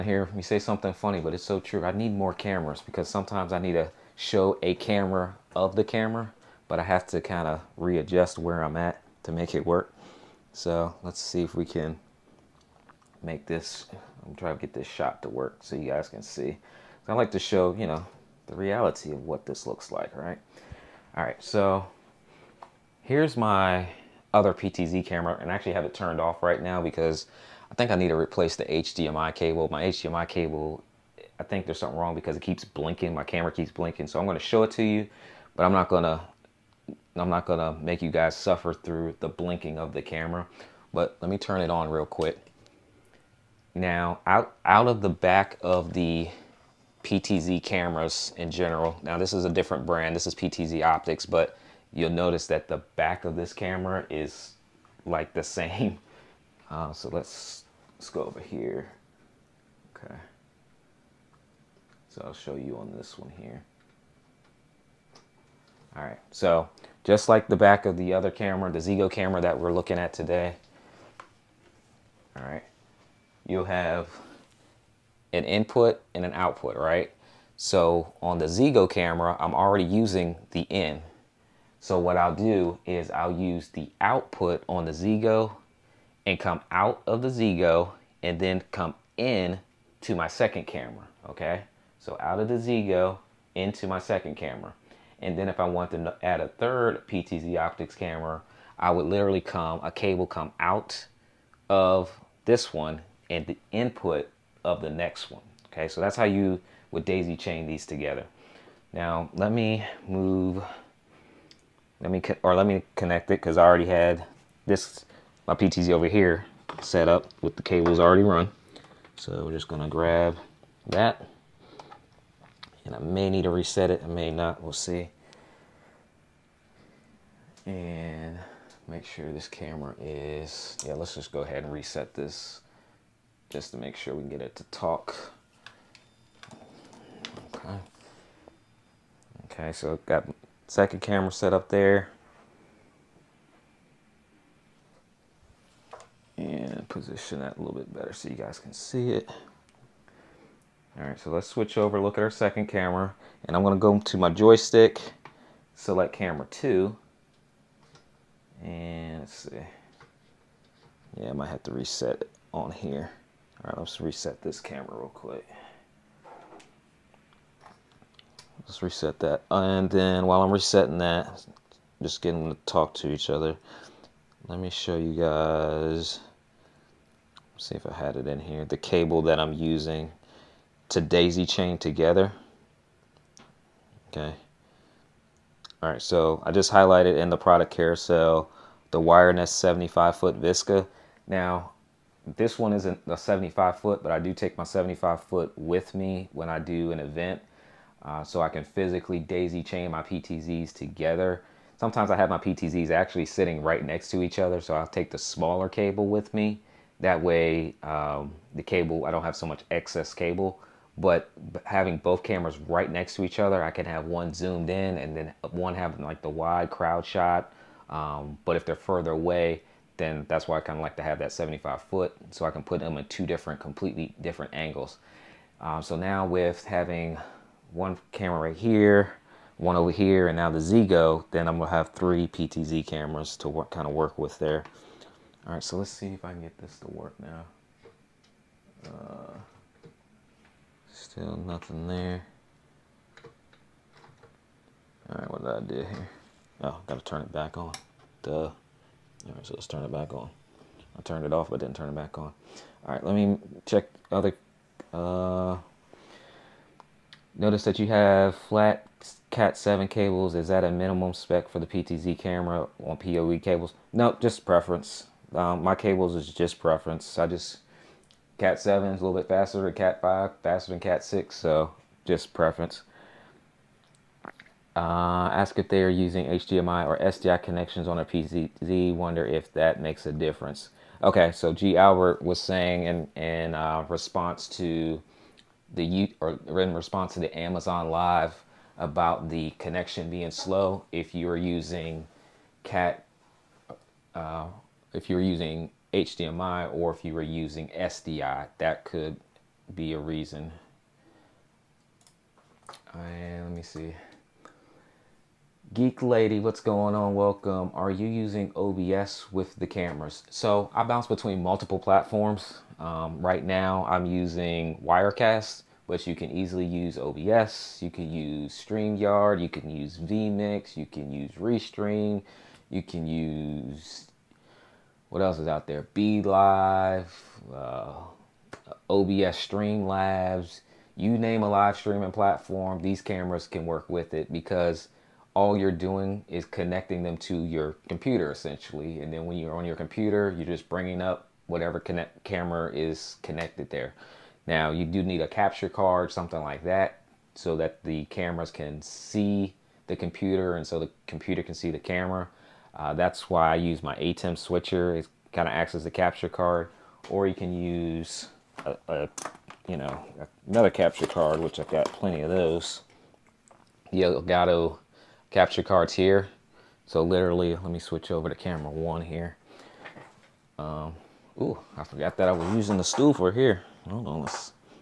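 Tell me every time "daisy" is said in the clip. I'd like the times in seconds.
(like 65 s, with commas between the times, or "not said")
107 s, 181 s, 199 s.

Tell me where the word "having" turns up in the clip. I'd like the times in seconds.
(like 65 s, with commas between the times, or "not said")
211 s, 215 s, 226 s.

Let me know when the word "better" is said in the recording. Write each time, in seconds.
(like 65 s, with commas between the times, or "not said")
147 s.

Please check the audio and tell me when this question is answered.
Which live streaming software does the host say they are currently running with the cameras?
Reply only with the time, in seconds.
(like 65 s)
314 s.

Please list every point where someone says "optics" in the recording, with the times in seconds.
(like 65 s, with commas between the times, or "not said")
50 s, 97 s.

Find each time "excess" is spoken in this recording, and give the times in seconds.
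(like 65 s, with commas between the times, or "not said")
209 s.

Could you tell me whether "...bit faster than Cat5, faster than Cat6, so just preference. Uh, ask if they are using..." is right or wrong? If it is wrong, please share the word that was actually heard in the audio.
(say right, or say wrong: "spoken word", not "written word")
right.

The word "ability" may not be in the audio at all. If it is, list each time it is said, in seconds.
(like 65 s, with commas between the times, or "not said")
not said.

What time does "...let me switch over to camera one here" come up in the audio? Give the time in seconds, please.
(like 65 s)
367 s.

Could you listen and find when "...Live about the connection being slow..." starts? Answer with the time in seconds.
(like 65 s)
287 s.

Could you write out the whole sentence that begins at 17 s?
I like to show, you know, the reality of what this looks like, right?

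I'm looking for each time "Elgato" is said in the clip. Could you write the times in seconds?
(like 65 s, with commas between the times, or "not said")
364 s.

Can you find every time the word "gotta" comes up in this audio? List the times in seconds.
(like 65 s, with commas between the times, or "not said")
246 s.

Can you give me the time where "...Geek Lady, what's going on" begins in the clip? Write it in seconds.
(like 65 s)
305 s.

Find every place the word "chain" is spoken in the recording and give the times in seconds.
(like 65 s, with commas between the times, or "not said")
107 s, 181 s, 199 s.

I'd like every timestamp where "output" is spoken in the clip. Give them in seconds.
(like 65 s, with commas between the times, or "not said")
76 s, 84 s.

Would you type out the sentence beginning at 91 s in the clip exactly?
So out of the ZEEGOO into my second camera.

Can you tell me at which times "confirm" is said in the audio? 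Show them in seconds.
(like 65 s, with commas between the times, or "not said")
not said.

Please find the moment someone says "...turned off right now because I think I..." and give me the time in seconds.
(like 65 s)
25 s.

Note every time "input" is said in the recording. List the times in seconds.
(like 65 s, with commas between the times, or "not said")
75 s, 103 s.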